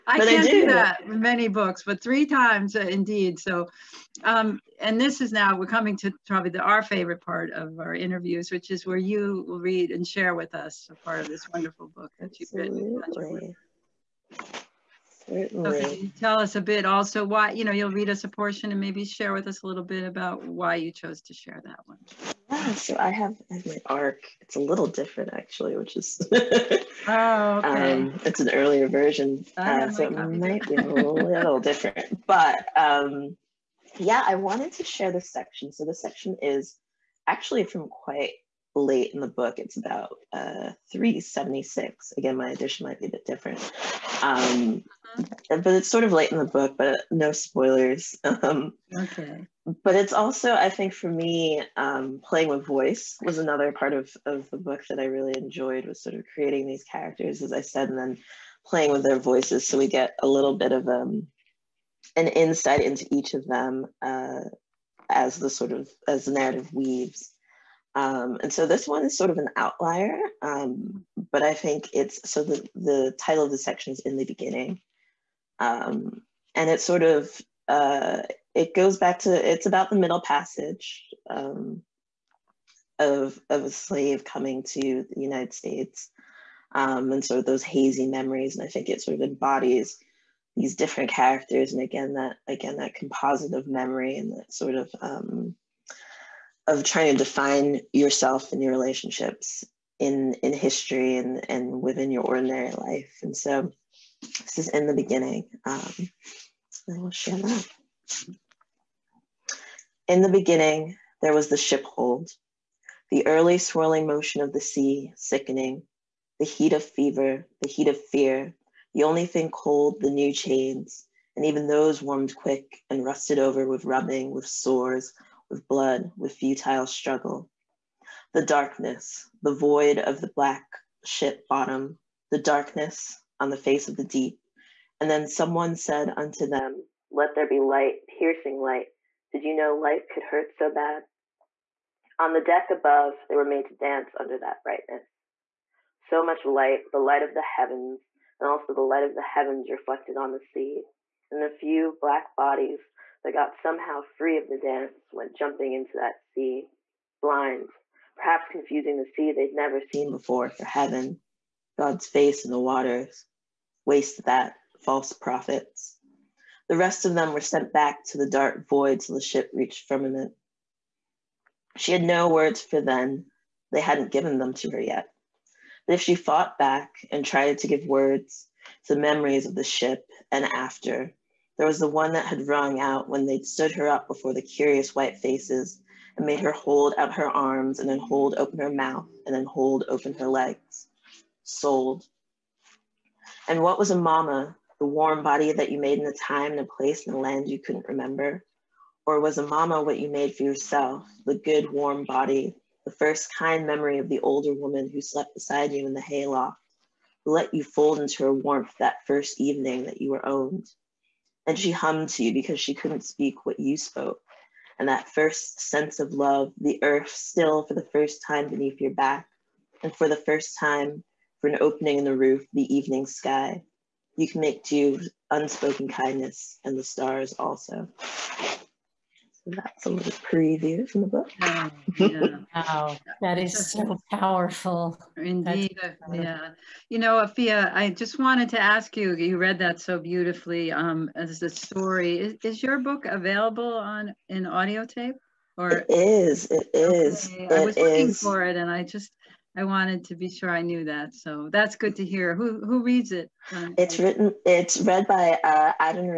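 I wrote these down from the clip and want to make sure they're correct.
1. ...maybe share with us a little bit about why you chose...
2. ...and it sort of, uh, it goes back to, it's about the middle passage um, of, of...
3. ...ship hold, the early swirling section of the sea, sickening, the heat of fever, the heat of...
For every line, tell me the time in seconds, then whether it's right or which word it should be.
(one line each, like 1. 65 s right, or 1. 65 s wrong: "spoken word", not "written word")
1. 18 s right
2. 76 s right
3. 111 s wrong: "motion", not "section".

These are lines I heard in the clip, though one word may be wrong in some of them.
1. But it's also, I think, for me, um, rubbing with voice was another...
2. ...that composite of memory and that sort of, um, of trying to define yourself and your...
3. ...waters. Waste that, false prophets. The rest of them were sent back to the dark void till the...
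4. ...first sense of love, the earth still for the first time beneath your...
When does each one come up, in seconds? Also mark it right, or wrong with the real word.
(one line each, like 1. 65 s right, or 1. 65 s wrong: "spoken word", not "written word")
1. 49 s wrong: "playing", not "rubbing"
2. 92 s right
3. 162 s right
4. 215 s right.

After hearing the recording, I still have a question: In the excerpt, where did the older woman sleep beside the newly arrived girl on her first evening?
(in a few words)
Hayloft.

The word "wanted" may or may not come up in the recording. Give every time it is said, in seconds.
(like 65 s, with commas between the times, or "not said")
34 s, 238 s, 249 s.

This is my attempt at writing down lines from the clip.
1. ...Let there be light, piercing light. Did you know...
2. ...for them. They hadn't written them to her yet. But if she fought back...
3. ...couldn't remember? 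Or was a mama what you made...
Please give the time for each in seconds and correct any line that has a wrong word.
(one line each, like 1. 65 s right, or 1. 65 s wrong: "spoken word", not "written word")
1. 137 s right
2. 172 s wrong: "given", not "written"
3. 197 s right.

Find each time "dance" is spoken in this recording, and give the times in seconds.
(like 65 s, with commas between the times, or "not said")
143 s, 154 s.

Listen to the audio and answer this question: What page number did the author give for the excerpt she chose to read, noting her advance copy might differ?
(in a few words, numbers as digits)
376.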